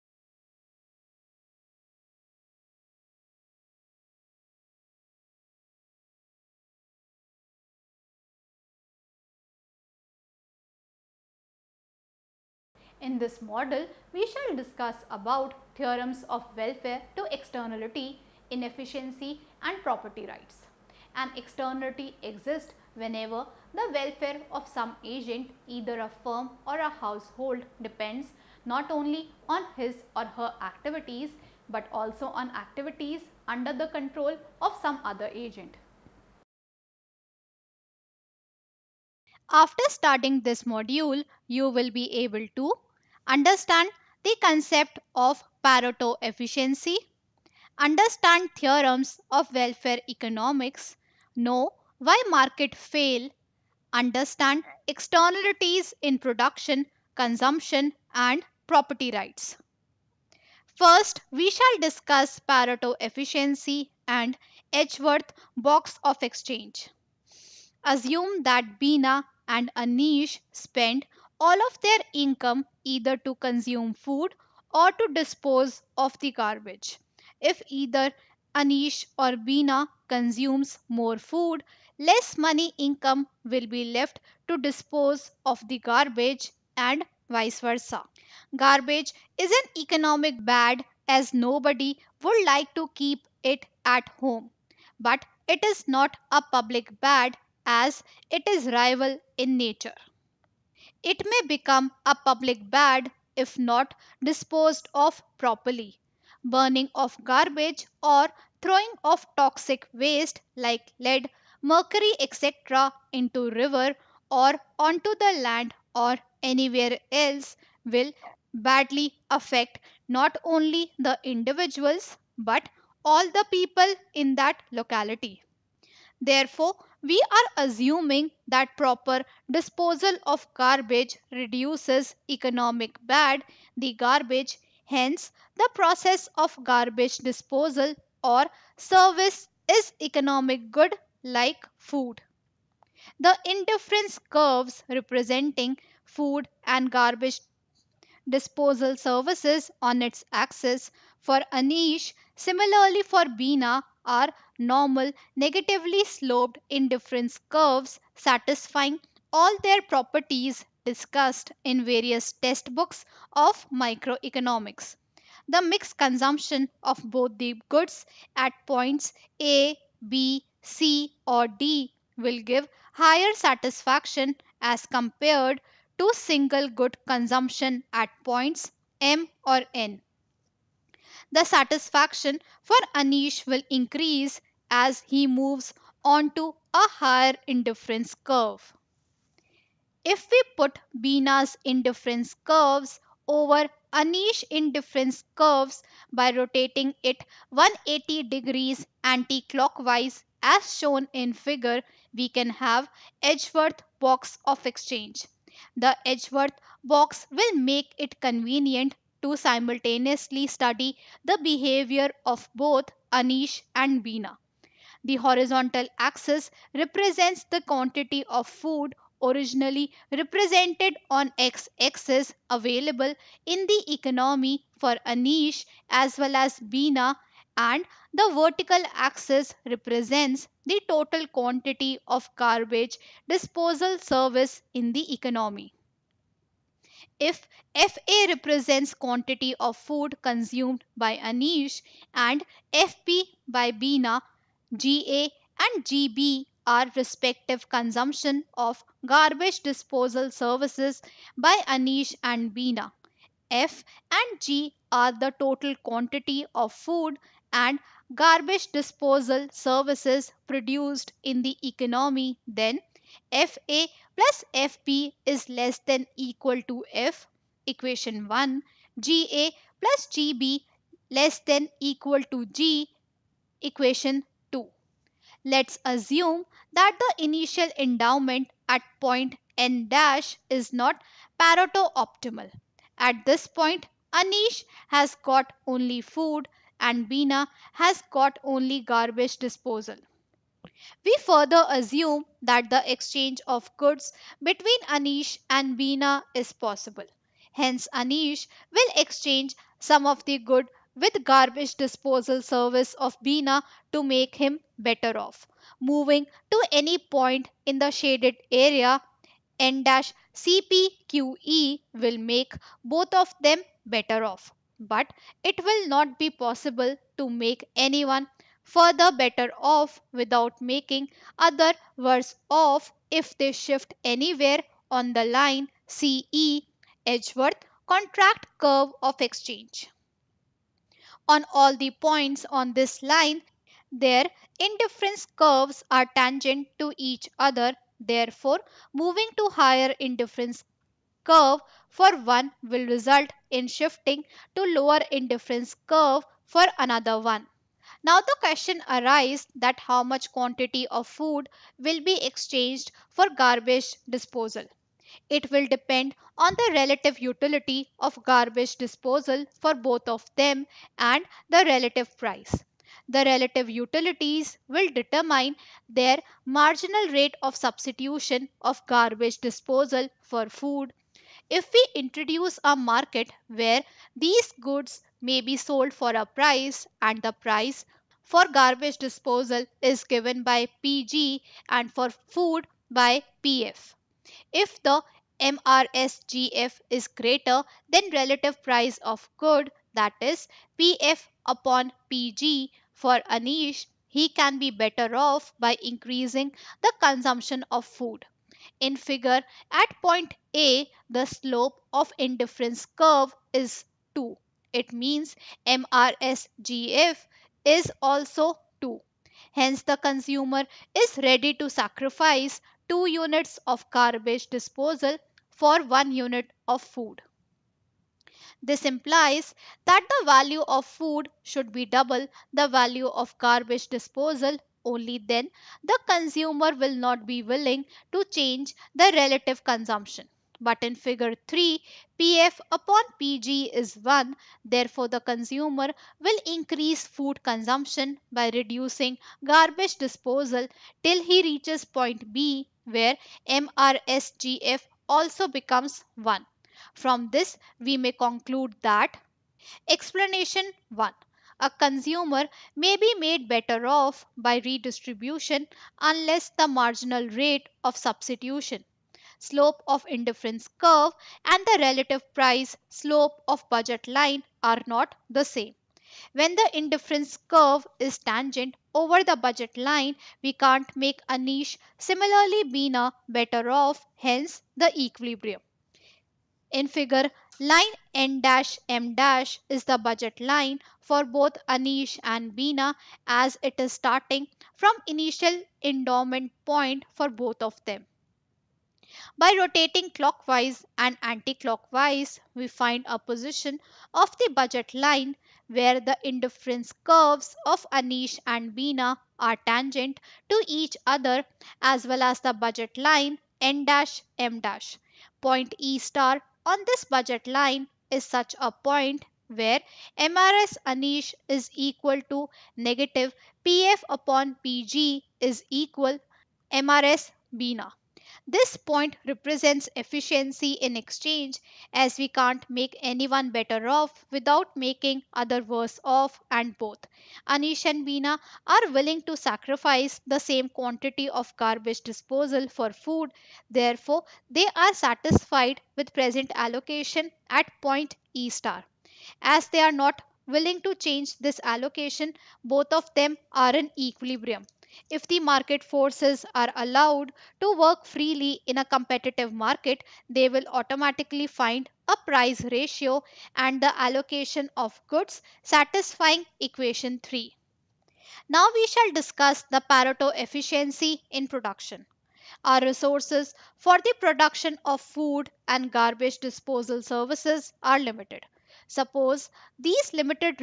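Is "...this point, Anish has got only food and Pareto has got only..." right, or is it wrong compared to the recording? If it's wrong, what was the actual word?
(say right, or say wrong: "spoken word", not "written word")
wrong: "Bina", not "Pareto".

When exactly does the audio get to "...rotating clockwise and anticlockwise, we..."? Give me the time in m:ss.
8:09.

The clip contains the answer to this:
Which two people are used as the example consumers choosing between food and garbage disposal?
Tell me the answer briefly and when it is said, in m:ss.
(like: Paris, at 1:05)
Bina and Anish, at 1:08.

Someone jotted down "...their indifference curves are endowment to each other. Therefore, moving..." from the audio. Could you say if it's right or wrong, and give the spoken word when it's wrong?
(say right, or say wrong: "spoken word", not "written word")
wrong: "tangent", not "endowment".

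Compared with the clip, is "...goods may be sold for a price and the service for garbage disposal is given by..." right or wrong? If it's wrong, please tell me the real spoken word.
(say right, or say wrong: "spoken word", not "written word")
wrong: "price", not "service".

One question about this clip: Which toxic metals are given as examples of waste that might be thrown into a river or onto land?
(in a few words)
lead, mercury.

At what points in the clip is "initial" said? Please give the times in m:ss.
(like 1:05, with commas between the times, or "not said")
4:37, 8:05.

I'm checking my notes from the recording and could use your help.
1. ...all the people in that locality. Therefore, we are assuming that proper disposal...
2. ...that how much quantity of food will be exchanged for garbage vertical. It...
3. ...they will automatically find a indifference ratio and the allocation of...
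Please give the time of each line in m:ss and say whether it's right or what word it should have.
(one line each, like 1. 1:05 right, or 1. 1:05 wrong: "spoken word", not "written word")
1. 2:03 right
2. 5:49 wrong: "disposal", not "vertical"
3. 9:10 wrong: "price", not "indifference".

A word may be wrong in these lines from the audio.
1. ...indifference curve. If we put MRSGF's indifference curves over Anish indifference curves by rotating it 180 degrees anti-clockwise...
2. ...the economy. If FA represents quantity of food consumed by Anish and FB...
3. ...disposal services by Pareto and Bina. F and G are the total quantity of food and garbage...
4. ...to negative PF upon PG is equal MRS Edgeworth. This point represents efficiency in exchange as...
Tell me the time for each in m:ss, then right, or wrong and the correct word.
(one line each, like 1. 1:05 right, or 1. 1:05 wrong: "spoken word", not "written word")
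1. 3:07 wrong: "Bina", not "MRSGF"
2. 3:54 right
3. 4:09 wrong: "Anish", not "Pareto"
4. 8:32 wrong: "Bina", not "Edgeworth".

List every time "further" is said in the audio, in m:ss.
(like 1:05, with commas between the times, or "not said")
4:51, 5:18.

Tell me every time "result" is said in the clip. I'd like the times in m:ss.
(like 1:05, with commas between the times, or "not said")
5:42.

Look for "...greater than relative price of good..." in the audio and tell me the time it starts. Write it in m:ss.
6:27.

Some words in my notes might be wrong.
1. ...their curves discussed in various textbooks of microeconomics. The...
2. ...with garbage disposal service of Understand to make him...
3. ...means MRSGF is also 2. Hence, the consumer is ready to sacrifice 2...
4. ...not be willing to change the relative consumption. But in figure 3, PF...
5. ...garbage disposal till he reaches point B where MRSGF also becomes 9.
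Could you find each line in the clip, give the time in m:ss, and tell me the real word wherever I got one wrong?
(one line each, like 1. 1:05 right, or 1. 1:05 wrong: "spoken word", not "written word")
1. 2:39 wrong: "properties", not "curves"
2. 5:00 wrong: "Bina", not "Understand"
3. 6:44 right
4. 7:06 right
5. 7:19 wrong: "1", not "9".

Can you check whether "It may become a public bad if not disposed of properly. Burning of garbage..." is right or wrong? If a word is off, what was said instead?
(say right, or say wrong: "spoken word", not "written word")
right.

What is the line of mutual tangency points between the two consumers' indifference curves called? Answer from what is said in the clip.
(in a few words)
Edgeworth contract curve of exchange.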